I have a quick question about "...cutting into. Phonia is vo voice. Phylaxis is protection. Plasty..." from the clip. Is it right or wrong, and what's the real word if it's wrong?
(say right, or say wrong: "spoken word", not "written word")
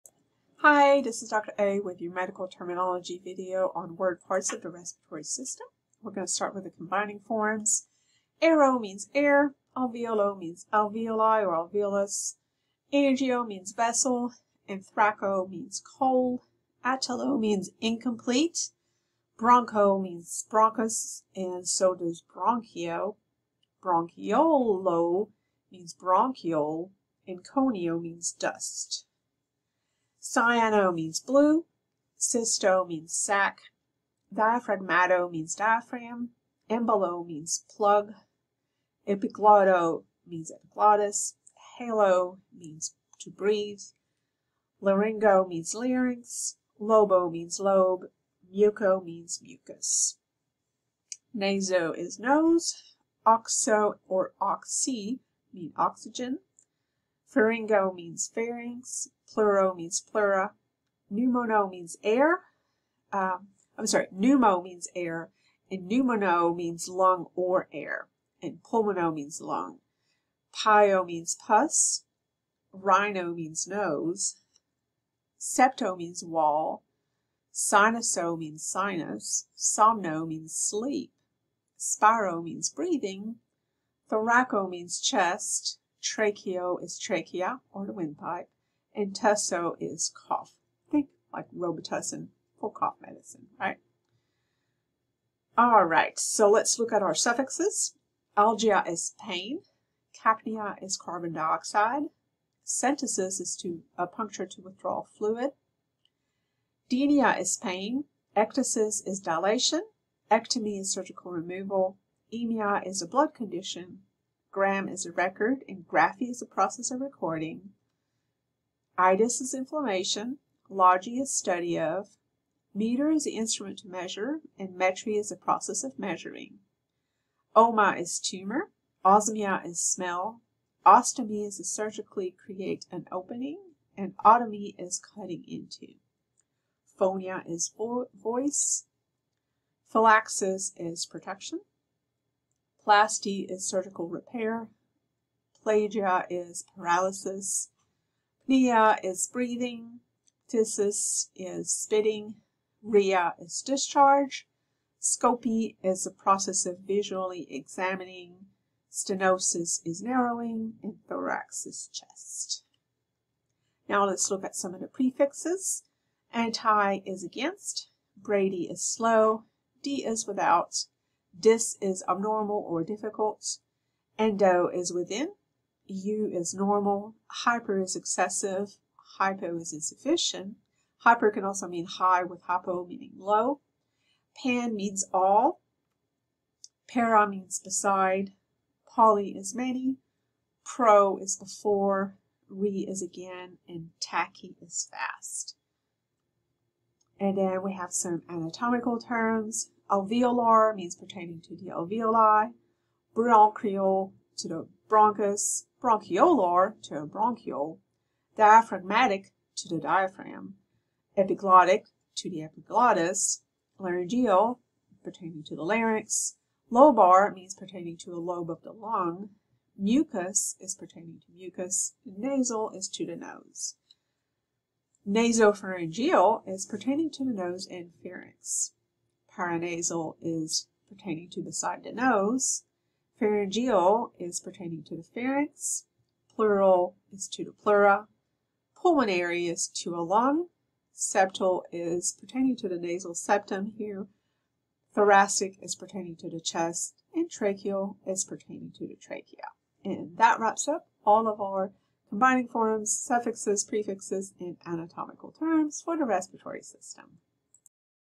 right.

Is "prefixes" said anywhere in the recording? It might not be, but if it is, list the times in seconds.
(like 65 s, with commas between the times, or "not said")
164 s, 253 s.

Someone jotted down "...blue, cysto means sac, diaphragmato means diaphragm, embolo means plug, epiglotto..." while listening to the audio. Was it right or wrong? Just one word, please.
right.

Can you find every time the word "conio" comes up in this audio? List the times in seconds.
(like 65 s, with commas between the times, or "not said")
27 s.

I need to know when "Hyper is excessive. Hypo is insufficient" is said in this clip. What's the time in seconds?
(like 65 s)
177 s.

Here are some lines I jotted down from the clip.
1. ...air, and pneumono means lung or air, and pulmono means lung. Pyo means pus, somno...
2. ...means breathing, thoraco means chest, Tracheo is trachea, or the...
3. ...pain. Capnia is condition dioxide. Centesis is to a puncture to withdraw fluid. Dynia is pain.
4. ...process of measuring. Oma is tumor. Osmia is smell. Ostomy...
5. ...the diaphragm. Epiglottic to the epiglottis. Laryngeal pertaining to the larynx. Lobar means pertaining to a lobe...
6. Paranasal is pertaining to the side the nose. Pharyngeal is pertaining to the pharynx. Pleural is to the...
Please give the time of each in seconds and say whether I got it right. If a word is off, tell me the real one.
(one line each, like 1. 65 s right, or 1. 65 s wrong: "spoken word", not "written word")
1. 64 s wrong: "rhino", not "somno"
2. 82 s right
3. 99 s wrong: "carbon", not "condition"
4. 125 s right
5. 209 s right
6. 229 s right.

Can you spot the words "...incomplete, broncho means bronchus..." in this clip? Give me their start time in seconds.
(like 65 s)
17 s.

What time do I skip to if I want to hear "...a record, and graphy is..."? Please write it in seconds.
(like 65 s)
115 s.